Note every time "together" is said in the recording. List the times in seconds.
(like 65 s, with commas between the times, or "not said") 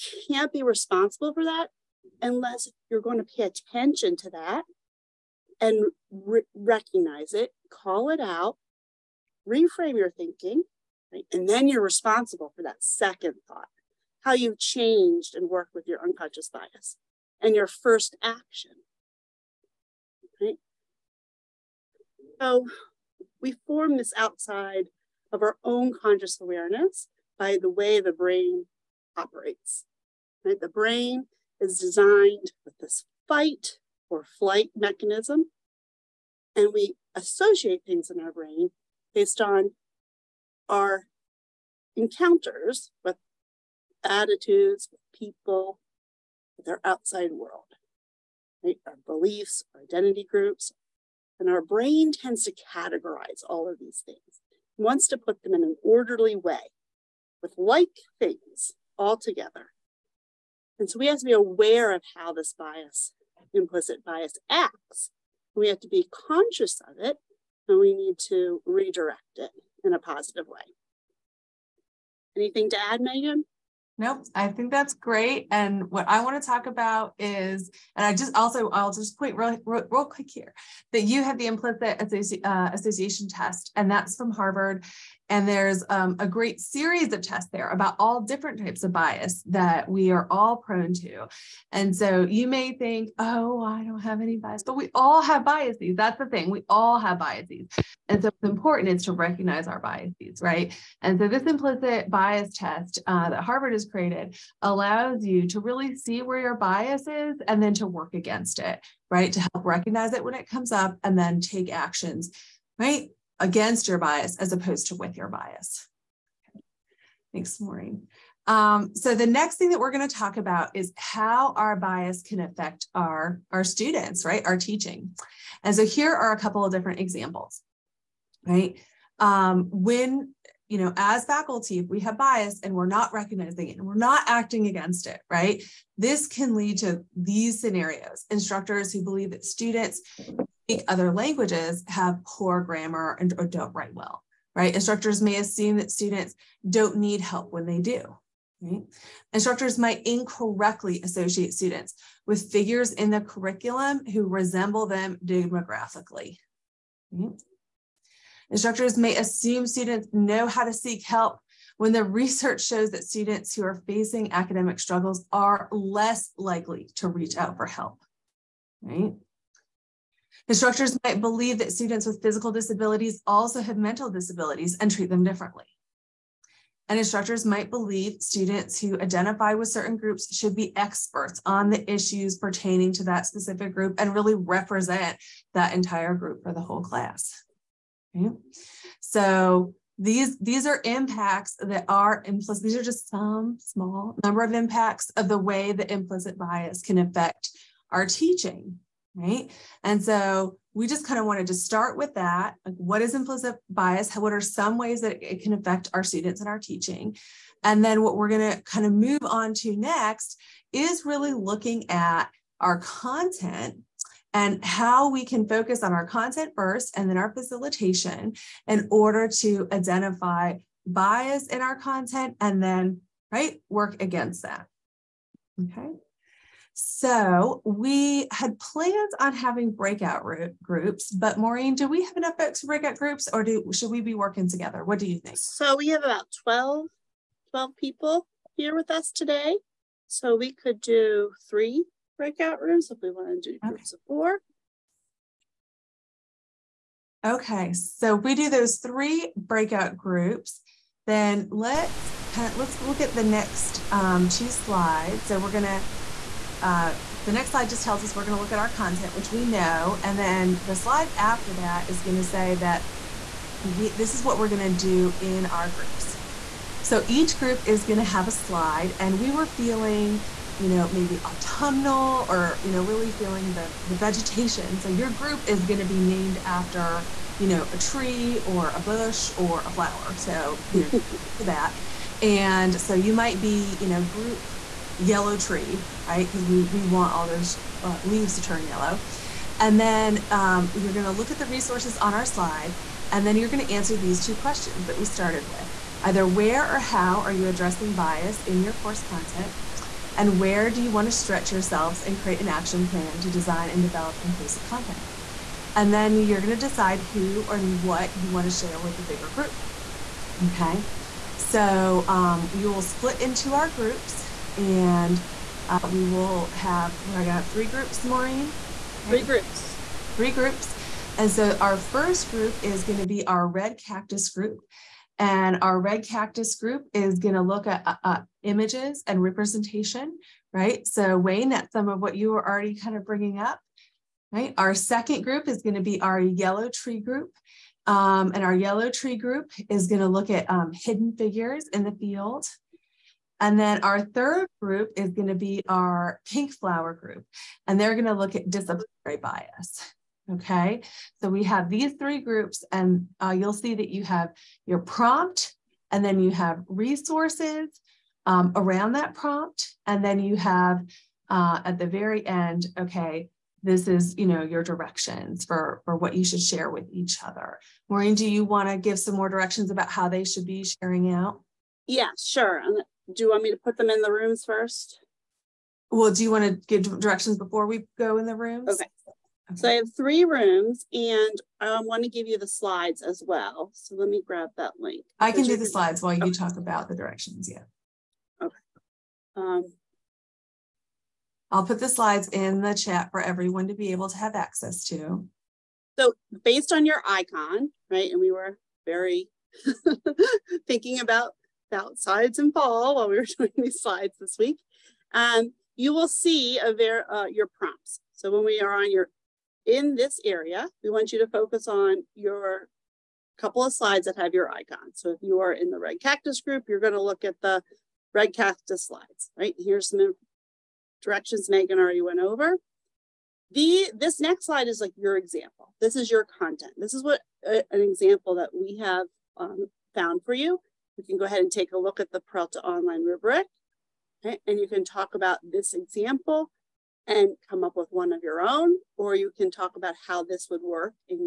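59 s, 234 s.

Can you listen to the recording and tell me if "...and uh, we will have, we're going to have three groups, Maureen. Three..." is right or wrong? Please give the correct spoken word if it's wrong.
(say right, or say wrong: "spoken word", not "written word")
right.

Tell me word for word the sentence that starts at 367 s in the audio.
Maureen, do you want to give some more directions about how they should be sharing out?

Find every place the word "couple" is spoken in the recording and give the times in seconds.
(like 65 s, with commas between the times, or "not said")
126 s, 413 s.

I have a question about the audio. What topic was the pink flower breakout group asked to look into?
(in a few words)
disciplinary bias.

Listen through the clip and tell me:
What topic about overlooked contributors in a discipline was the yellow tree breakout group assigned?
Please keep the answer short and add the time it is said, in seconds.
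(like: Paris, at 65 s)
hidden figures in the field, at 340 s.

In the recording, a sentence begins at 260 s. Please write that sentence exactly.
And then the slide after that is going to say that we, this is what we're going to do in our groups.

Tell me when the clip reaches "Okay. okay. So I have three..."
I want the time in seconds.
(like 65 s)
378 s.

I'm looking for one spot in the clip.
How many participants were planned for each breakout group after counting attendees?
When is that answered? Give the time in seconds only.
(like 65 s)
244 s.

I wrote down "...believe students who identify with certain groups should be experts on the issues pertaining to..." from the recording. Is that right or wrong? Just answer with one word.
right.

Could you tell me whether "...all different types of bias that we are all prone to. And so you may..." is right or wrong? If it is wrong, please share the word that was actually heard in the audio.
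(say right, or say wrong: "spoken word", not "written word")
right.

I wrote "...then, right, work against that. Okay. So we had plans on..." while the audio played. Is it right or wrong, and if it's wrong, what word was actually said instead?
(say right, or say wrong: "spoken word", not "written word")
right.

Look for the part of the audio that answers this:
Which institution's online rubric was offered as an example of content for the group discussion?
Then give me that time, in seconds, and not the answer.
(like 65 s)
432 s.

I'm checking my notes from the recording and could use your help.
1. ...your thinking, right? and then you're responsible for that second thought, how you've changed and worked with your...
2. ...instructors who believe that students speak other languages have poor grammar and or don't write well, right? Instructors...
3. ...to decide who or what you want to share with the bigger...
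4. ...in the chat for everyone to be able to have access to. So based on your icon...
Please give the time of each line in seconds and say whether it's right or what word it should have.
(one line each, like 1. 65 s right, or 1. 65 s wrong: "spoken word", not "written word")
1. 9 s right
2. 138 s right
3. 306 s right
4. 392 s right.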